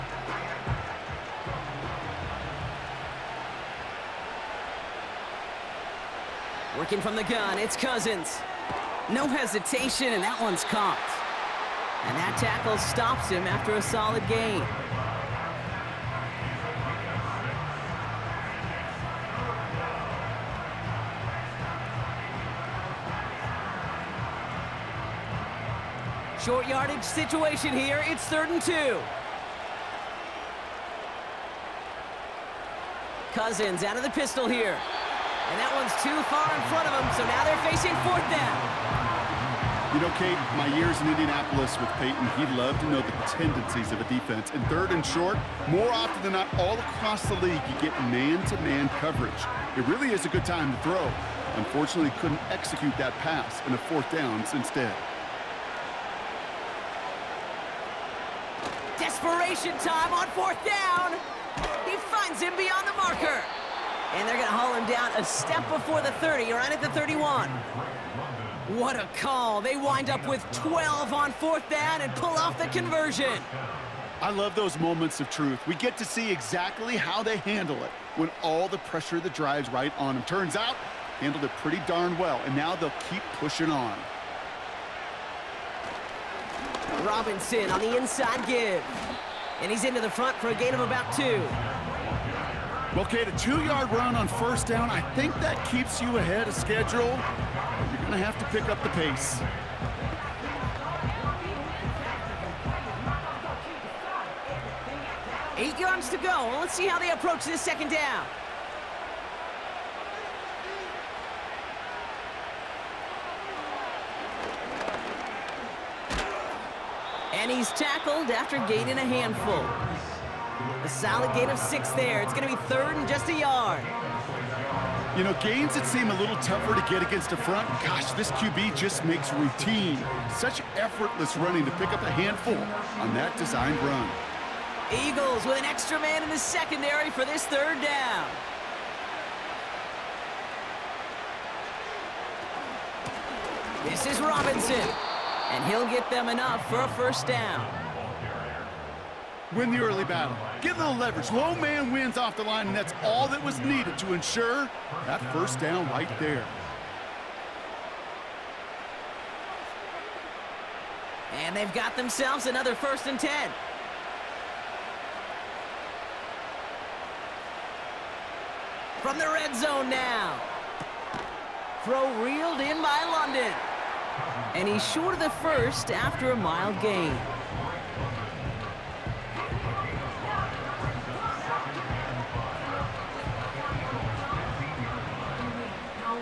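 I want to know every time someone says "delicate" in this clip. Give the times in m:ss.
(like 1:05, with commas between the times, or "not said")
not said.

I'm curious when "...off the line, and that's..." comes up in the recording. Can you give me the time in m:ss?
2:32.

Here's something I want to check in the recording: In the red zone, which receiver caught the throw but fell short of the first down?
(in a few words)
London.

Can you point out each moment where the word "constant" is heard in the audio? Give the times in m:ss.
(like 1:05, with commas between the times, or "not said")
not said.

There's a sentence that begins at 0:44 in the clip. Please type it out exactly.
And third and short, more often than not, all across the league, you get man-to-man -man coverage.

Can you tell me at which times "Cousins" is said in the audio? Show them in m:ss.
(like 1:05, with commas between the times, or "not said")
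0:07, 0:33.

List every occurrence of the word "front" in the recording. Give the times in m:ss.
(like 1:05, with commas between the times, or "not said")
0:36, 1:30, 2:07.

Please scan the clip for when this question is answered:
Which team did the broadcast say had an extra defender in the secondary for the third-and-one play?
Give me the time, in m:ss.
2:15.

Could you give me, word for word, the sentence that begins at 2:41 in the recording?
And they've got themselves another first and 10.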